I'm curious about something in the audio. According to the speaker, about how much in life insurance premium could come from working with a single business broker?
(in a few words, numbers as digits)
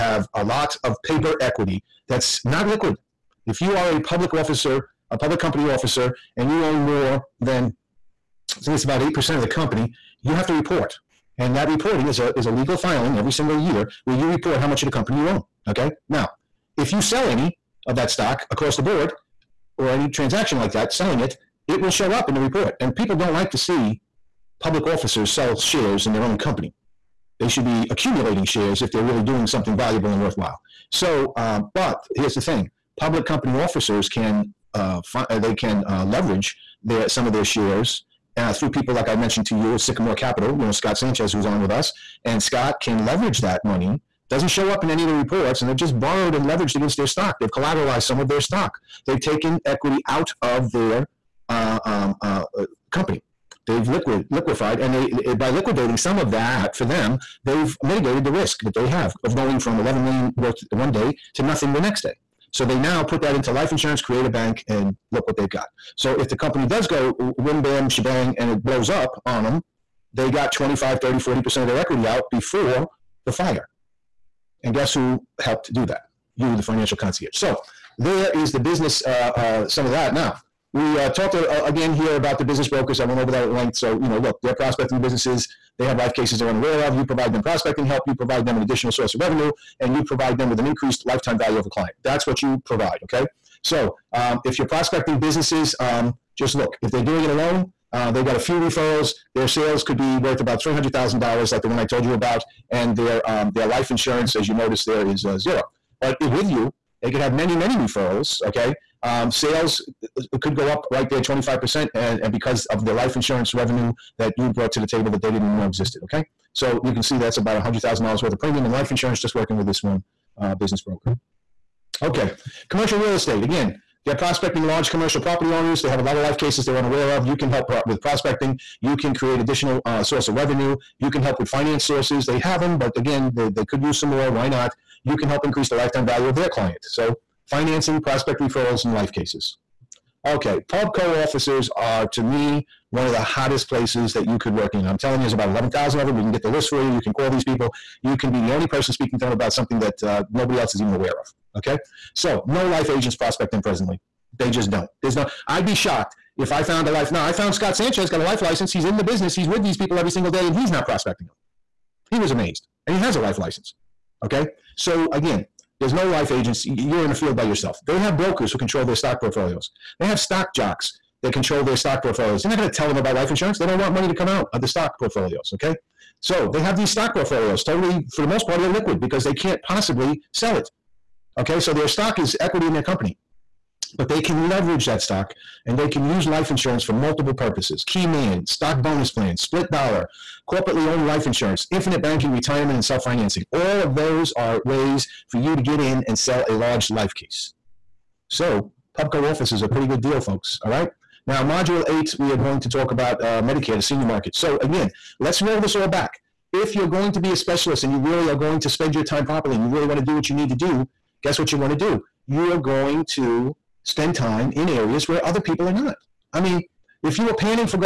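$100,000.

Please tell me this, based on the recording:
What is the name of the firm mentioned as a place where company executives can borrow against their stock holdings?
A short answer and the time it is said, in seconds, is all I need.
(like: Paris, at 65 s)
Sycamore Capital, at 39 s.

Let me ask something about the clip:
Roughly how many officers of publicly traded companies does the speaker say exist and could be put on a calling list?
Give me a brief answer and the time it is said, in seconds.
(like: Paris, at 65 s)
11,000, at 145 s.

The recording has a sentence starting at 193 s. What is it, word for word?
All of those are ways for you to get in and sell a large life case.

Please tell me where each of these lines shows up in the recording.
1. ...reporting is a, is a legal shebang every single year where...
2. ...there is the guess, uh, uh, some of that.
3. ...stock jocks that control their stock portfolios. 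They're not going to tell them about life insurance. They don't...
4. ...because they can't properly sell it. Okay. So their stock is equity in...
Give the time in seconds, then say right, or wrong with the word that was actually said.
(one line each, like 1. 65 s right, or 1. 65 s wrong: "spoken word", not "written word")
1. 11 s wrong: "filing", not "shebang"
2. 77 s wrong: "business", not "guess"
3. 170 s right
4. 178 s wrong: "possibly", not "properly".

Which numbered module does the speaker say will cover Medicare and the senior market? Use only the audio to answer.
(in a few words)
Module 8.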